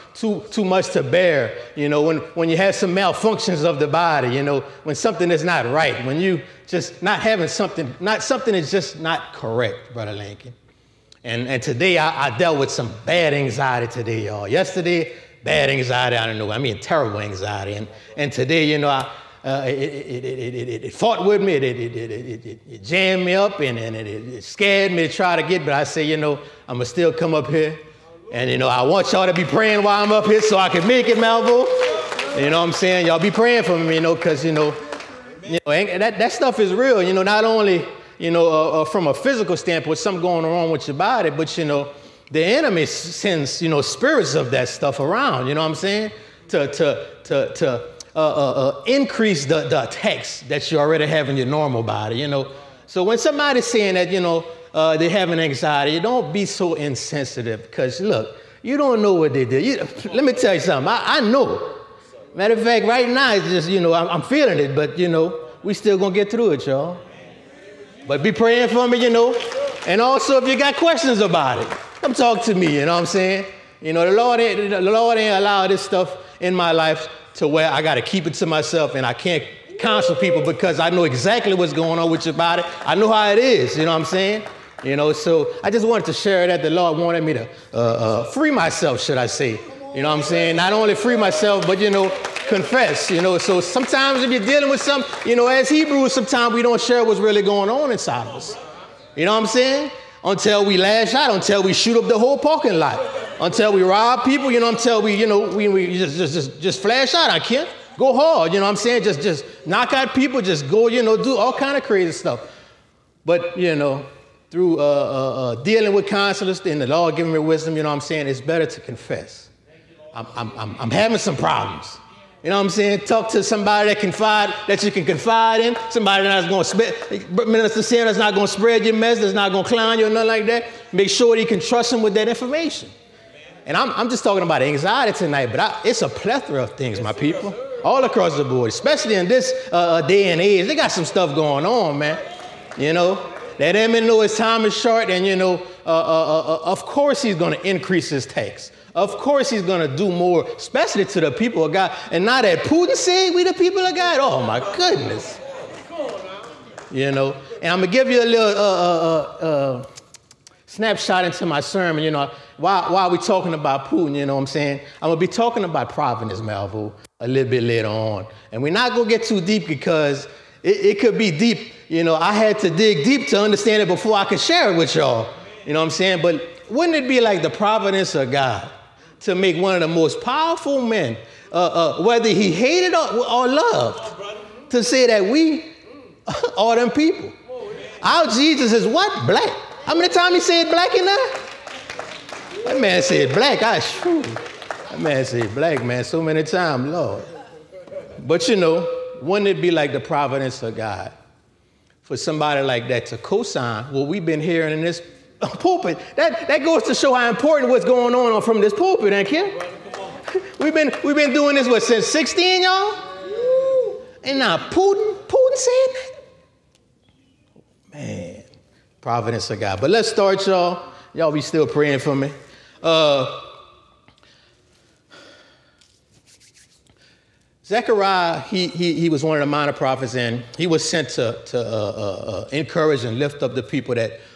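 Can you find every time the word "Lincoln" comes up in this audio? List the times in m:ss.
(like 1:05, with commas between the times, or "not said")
0:10.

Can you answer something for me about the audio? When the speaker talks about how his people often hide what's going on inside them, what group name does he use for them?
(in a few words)
Hebrews.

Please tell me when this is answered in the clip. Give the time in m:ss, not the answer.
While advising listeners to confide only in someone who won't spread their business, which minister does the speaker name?
2:07.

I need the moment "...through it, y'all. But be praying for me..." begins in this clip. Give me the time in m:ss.
1:06.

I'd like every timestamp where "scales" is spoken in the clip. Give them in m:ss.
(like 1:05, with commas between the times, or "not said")
not said.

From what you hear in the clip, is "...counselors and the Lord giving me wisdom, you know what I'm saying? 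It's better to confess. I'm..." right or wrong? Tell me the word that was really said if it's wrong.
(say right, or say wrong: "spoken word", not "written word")
right.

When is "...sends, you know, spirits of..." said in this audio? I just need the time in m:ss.
0:42.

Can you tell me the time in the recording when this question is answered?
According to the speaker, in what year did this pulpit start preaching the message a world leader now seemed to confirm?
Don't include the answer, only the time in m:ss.
3:32.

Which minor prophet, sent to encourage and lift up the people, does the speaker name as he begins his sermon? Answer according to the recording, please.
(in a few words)
Zechariah.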